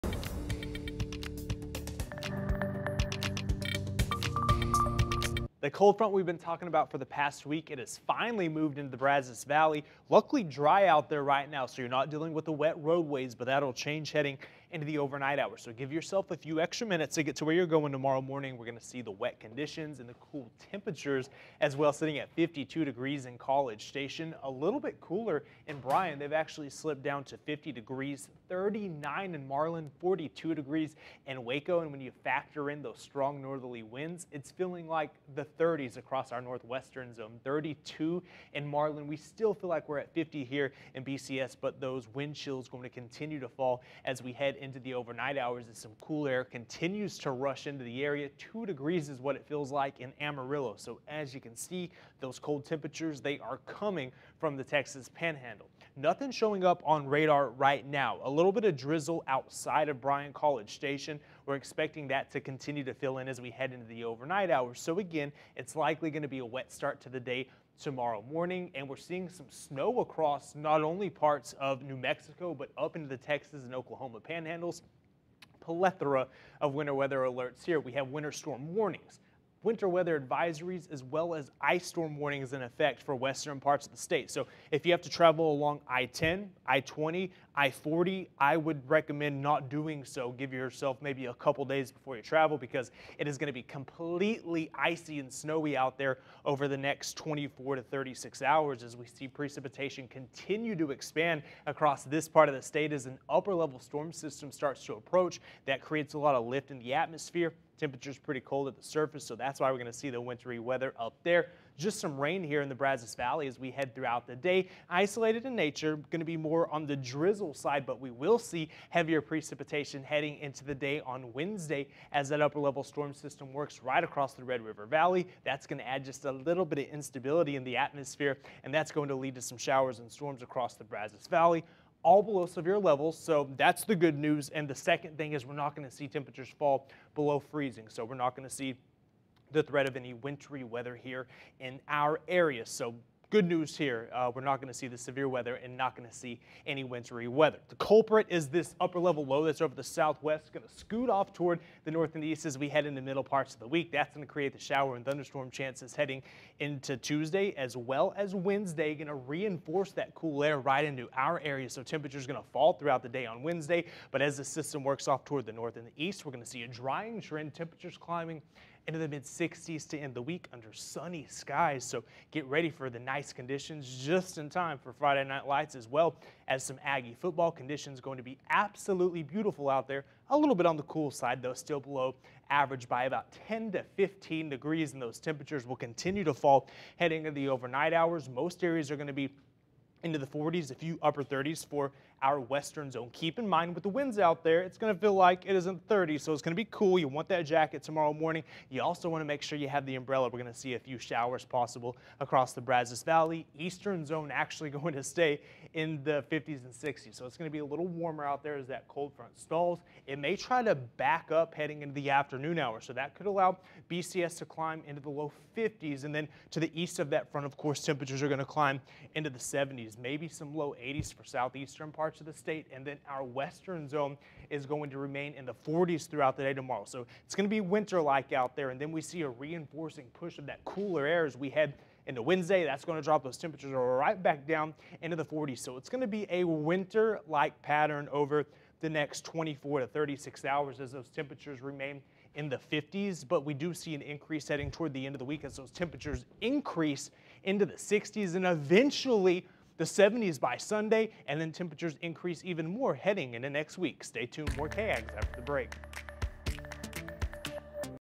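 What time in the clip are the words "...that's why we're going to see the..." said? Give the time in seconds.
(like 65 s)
109 s.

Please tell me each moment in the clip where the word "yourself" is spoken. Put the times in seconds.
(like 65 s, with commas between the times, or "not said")
15 s, 90 s.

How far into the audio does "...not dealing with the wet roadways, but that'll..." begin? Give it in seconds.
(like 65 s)
11 s.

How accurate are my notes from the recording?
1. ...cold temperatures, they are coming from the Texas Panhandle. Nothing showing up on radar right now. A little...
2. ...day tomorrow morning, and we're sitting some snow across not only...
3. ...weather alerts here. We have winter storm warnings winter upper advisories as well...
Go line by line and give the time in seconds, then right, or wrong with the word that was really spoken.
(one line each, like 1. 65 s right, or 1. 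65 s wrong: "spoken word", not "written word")
1. 52 s right
2. 67 s wrong: "seeing", not "sitting"
3. 76 s wrong: "weather", not "upper".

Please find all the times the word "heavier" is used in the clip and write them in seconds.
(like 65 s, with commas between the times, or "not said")
118 s.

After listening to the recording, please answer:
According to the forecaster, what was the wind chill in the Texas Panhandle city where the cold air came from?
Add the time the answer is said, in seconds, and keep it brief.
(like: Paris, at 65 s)
2 degrees, at 48 s.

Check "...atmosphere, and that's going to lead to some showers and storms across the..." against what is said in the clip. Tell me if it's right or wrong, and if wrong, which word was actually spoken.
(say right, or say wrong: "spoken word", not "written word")
right.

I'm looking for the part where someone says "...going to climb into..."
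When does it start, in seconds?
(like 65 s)
218 s.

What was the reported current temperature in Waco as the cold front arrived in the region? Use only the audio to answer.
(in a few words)
42 degrees.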